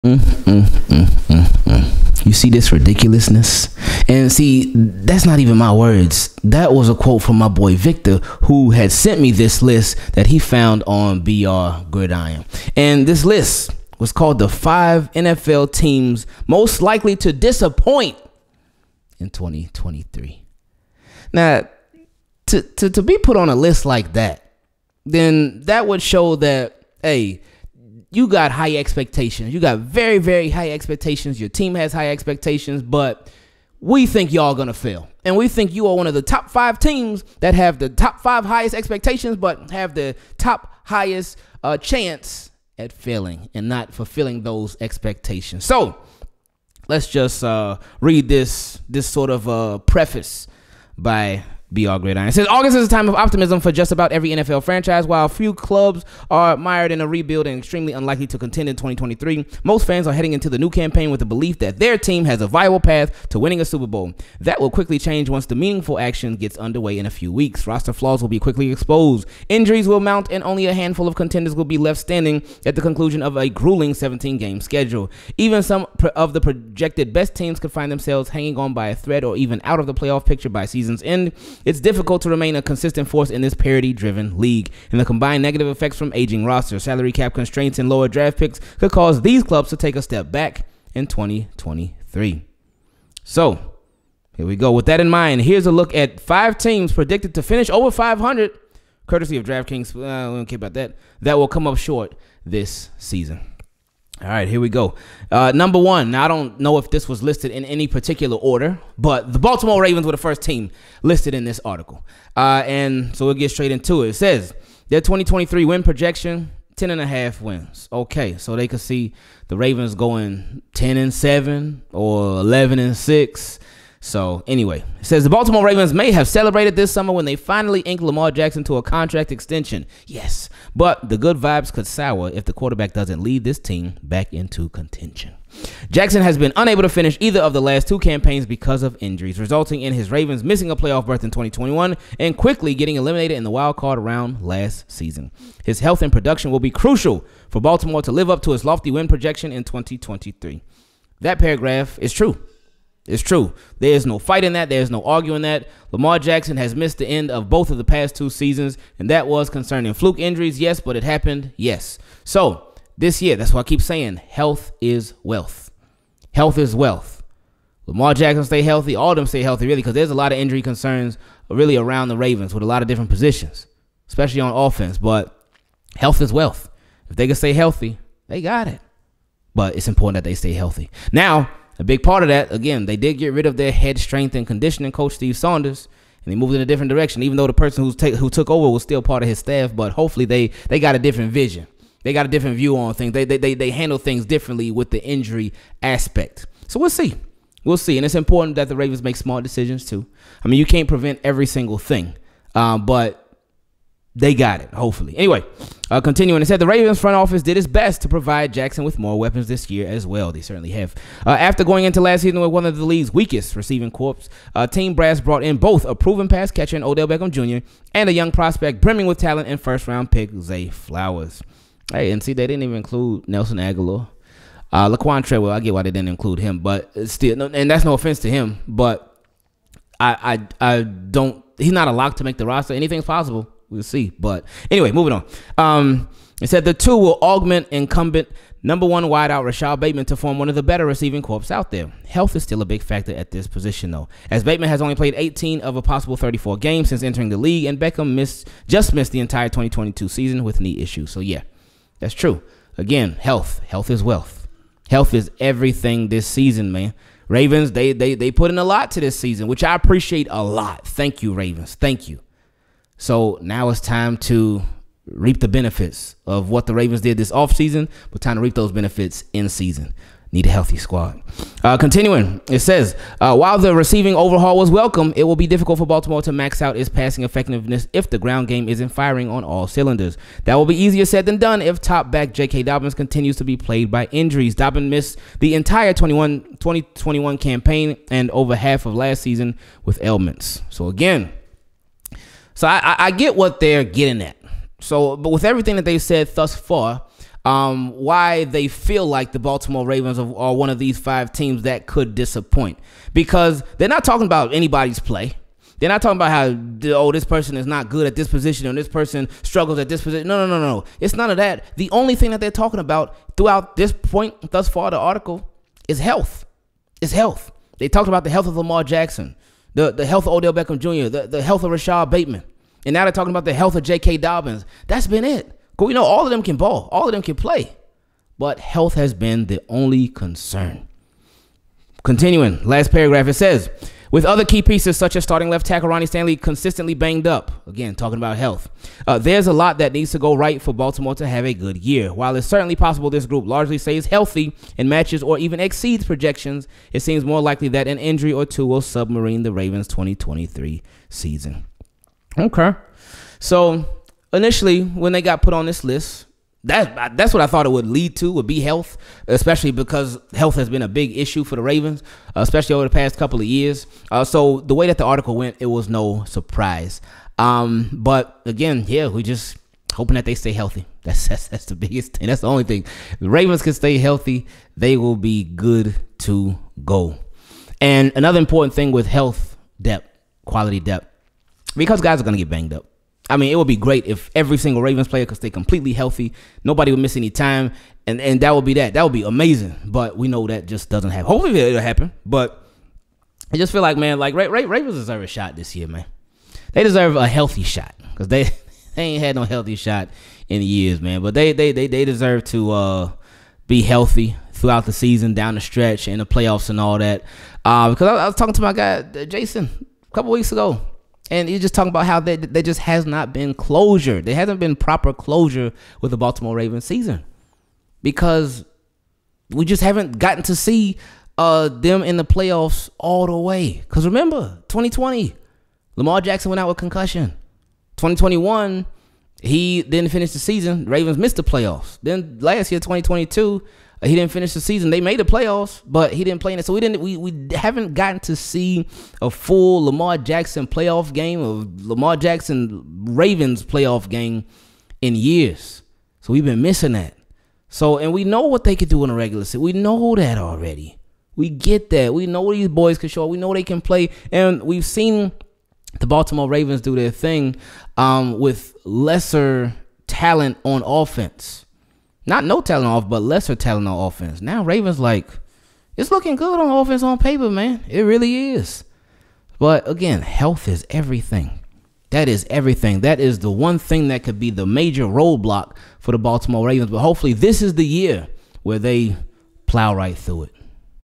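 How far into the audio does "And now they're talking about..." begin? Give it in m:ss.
5:22.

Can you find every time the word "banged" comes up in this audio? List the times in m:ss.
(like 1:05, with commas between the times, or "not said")
5:36, 6:22.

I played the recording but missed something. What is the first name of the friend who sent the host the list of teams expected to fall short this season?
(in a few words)
Victor.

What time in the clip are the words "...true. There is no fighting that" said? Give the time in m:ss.
2:33.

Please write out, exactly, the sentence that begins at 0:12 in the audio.
And this list was called the five NFL teams most likely to disappoint in 2023.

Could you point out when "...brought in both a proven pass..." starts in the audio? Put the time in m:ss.
3:35.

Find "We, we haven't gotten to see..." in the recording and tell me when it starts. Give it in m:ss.
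7:17.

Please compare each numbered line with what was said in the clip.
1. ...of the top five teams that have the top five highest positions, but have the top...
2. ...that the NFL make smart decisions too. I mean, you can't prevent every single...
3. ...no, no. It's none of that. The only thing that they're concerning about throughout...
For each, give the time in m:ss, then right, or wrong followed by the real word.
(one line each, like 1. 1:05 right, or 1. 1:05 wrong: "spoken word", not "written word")
1. 0:36 wrong: "expectations", not "positions"
2. 3:18 wrong: "Ravens", not "NFL"
3. 5:10 wrong: "talking", not "concerning".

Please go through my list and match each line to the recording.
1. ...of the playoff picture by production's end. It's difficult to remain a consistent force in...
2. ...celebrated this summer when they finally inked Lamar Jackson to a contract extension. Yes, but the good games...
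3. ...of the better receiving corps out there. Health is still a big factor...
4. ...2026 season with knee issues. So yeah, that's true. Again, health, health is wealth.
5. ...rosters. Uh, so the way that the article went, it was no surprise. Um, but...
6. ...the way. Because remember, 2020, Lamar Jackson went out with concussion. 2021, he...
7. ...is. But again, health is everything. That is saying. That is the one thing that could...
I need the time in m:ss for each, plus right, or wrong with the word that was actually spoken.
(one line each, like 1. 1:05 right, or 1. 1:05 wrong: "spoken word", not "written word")
1. 1:19 wrong: "season", not "production"
2. 2:06 wrong: "vibes", not "games"
3. 4:00 right
4. 4:09 wrong: "2022", not "2026"
5. 6:03 wrong: "years", not "rosters"
6. 7:03 right
7. 7:48 wrong: "everything", not "saying".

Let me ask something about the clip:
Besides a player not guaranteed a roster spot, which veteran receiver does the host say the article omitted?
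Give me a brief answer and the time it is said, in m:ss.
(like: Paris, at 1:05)
Nelson Agholor, at 3:43.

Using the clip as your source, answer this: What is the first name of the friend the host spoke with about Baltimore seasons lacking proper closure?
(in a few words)
Jason.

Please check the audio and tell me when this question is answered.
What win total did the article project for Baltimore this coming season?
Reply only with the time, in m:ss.
1:56.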